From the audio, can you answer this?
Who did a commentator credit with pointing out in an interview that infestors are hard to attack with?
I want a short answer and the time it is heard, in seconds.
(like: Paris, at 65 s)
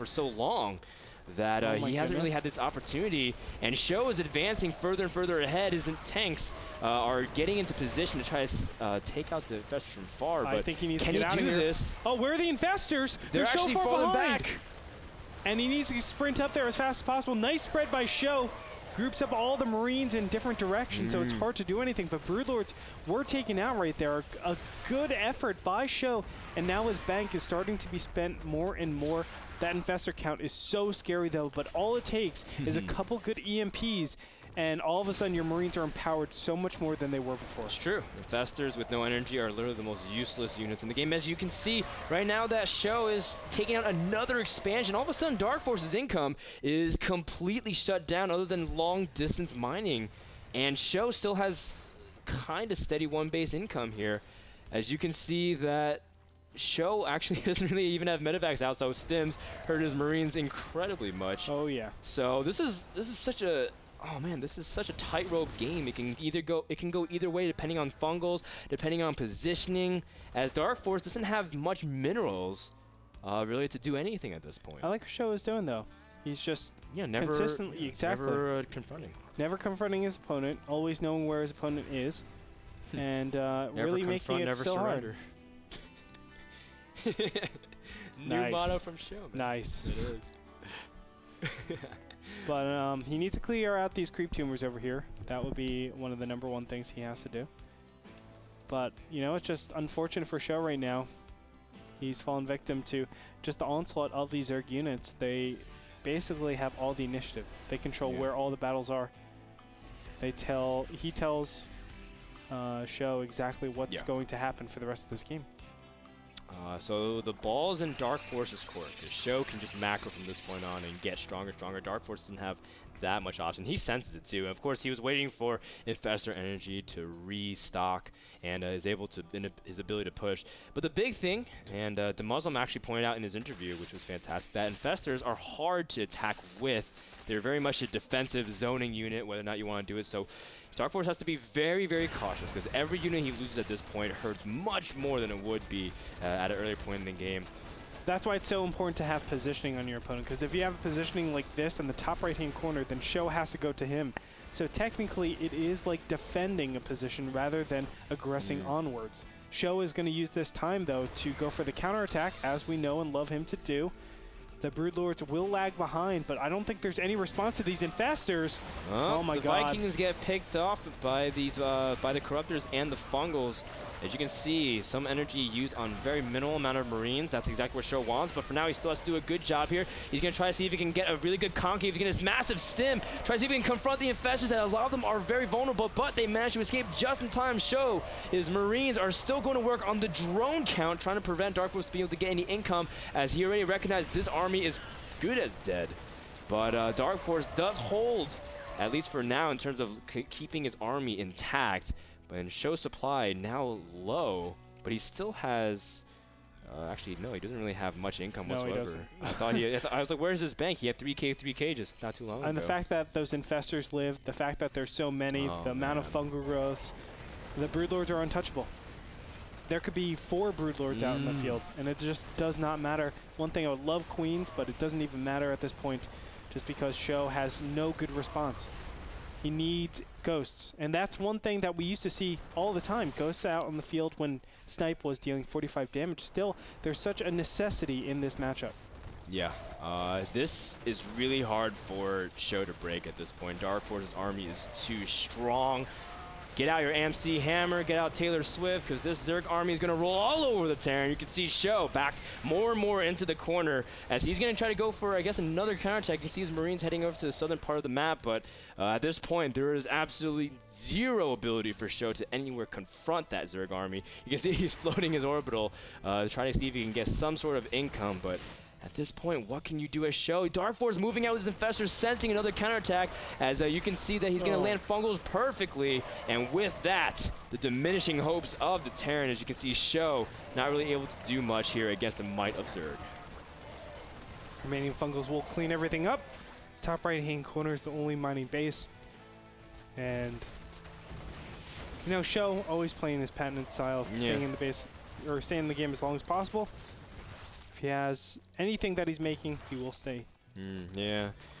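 Muslim, at 132 s.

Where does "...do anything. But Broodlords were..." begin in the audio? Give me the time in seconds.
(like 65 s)
21 s.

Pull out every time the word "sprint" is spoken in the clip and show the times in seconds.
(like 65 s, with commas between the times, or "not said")
16 s.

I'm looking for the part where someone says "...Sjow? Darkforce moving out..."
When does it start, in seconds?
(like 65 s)
270 s.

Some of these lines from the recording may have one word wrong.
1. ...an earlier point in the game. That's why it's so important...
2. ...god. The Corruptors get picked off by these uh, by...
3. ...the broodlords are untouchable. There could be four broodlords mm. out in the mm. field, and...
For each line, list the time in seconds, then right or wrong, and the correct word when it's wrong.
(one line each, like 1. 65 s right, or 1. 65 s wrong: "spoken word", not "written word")
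1. 146 s right
2. 169 s wrong: "Vikings", not "Corruptors"
3. 217 s right.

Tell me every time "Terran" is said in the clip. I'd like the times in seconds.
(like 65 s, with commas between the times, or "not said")
250 s, 278 s.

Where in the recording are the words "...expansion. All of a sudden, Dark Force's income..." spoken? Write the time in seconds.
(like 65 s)
44 s.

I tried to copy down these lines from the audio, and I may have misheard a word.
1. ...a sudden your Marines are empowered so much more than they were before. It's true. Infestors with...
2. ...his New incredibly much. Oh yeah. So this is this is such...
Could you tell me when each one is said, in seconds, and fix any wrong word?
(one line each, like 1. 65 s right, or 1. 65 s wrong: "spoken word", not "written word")
1. 35 s right
2. 59 s wrong: "Marines", not "New".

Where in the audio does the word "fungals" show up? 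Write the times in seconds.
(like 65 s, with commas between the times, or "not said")
67 s, 172 s, 216 s, 274 s, 284 s.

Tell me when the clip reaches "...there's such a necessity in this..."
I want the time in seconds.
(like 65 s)
236 s.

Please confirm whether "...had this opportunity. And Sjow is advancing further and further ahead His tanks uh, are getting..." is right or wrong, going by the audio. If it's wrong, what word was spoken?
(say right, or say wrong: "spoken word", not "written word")
right.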